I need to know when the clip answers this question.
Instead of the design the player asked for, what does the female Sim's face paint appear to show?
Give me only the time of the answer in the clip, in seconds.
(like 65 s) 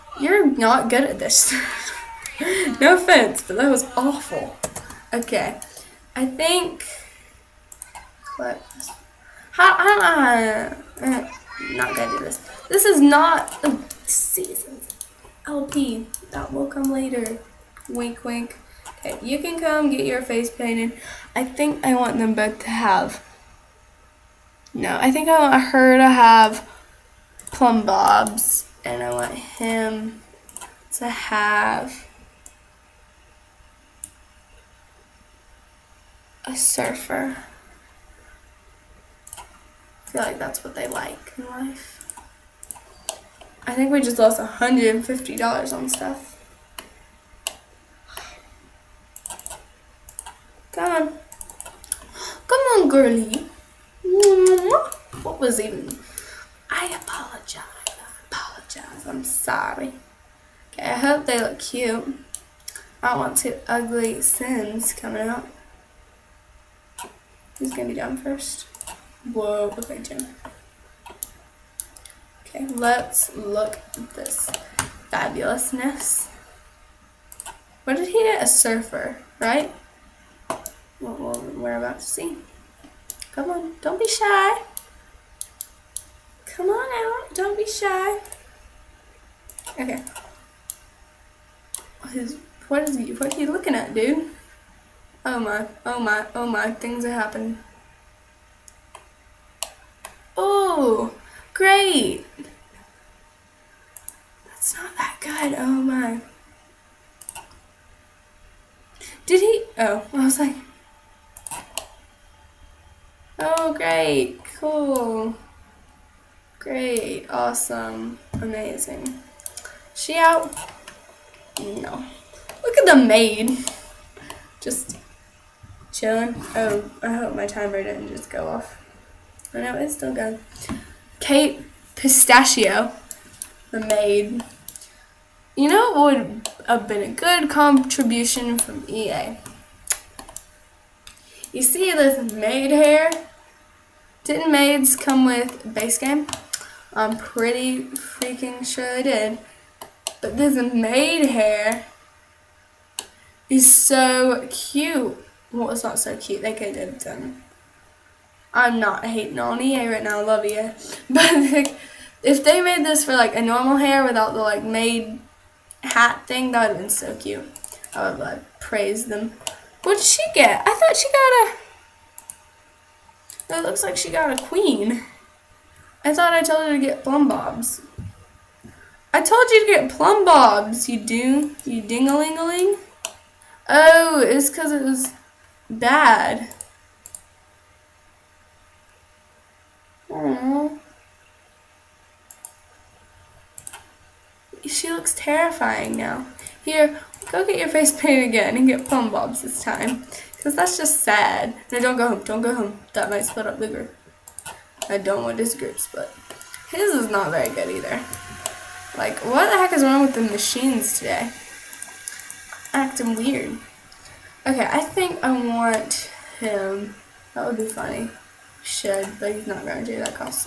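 174 s.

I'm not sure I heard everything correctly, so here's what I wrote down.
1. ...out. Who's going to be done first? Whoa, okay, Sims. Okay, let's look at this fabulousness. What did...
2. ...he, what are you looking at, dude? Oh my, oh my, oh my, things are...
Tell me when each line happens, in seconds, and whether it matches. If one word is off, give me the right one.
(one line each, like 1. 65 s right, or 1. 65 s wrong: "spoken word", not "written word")
1. 65 s wrong: "Jim", not "Sims"
2. 92 s right.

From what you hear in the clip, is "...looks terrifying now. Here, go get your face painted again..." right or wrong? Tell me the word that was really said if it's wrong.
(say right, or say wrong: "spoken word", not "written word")
right.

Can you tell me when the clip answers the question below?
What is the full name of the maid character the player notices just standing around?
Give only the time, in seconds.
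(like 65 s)
131 s.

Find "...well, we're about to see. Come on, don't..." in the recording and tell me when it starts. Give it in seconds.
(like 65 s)
81 s.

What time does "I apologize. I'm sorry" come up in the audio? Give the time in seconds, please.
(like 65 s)
57 s.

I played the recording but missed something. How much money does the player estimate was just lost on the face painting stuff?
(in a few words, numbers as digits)
$150.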